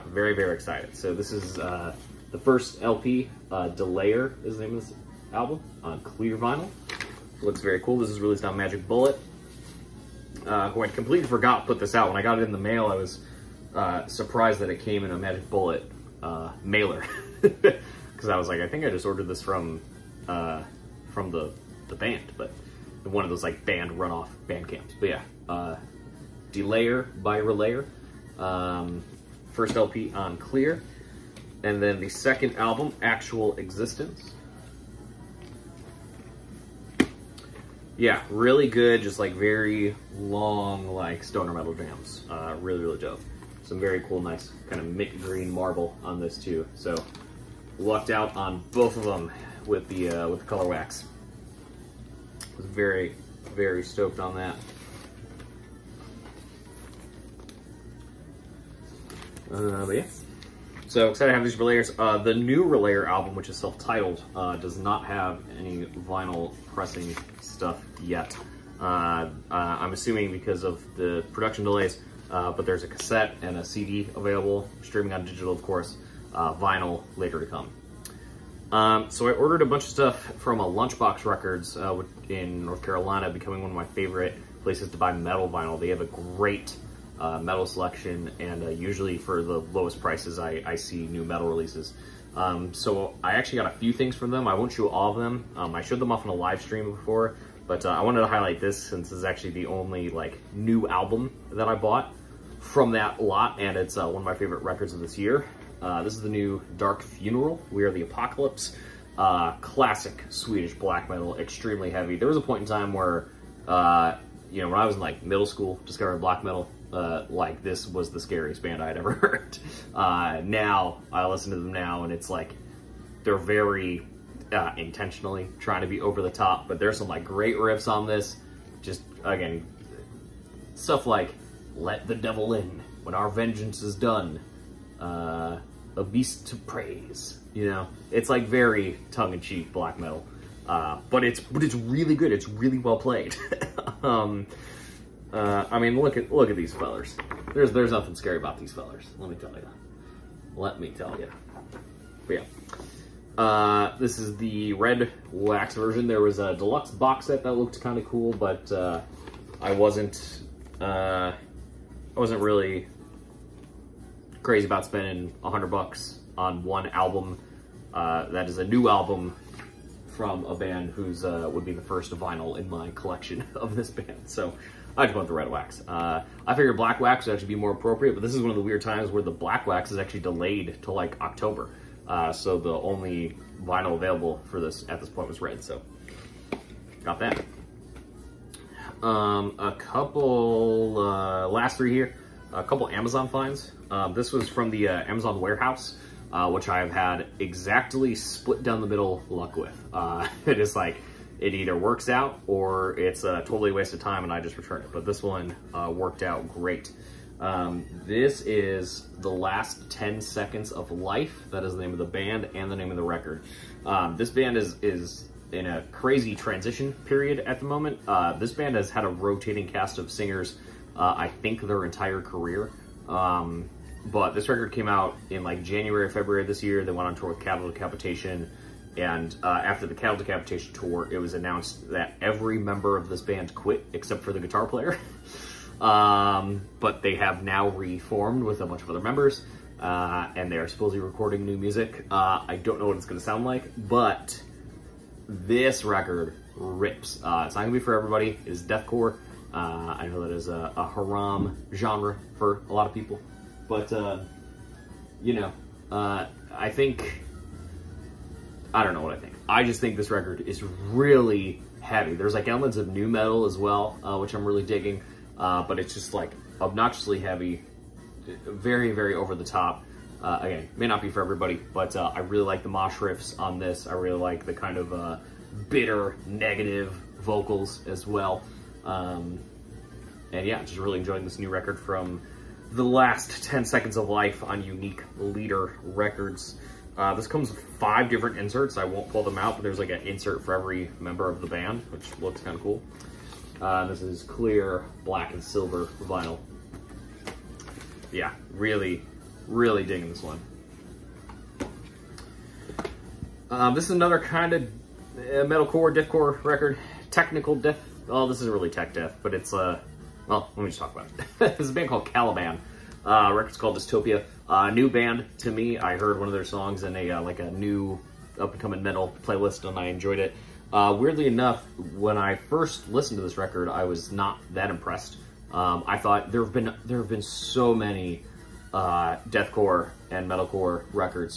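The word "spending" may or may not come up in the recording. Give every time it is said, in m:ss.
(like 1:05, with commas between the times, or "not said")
2:44.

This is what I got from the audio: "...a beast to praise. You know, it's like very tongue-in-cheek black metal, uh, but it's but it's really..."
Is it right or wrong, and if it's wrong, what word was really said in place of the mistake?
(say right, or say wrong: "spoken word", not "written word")
right.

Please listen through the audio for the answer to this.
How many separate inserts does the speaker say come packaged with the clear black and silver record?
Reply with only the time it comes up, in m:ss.
4:47.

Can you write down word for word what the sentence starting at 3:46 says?
They went on tour with Cattle Decapitation.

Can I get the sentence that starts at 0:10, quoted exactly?
Uh, who I completely forgot put this out.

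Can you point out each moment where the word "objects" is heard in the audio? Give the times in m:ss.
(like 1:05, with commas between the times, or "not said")
not said.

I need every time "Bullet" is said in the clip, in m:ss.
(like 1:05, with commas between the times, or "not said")
0:08, 0:15.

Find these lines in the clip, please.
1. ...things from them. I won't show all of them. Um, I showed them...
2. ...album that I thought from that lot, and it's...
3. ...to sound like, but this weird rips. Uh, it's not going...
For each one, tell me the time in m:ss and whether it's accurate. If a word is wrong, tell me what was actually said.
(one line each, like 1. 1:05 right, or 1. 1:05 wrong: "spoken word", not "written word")
1. 1:33 right
2. 1:40 wrong: "bought", not "thought"
3. 4:03 wrong: "record", not "weird".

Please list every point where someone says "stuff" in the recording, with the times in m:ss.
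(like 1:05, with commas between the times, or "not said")
1:07, 1:19, 2:10.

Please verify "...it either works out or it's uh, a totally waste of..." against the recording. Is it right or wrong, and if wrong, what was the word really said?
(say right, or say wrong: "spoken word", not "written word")
right.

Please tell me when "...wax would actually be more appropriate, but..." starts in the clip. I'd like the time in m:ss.
2:57.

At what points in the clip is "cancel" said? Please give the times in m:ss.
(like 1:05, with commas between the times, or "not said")
not said.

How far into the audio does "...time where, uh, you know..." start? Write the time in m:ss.
1:52.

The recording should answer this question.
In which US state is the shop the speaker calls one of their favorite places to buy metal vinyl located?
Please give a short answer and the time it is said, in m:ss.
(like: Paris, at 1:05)
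North Carolina, at 1:22.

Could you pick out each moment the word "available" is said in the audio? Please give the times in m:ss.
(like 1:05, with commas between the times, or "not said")
1:14, 3:03.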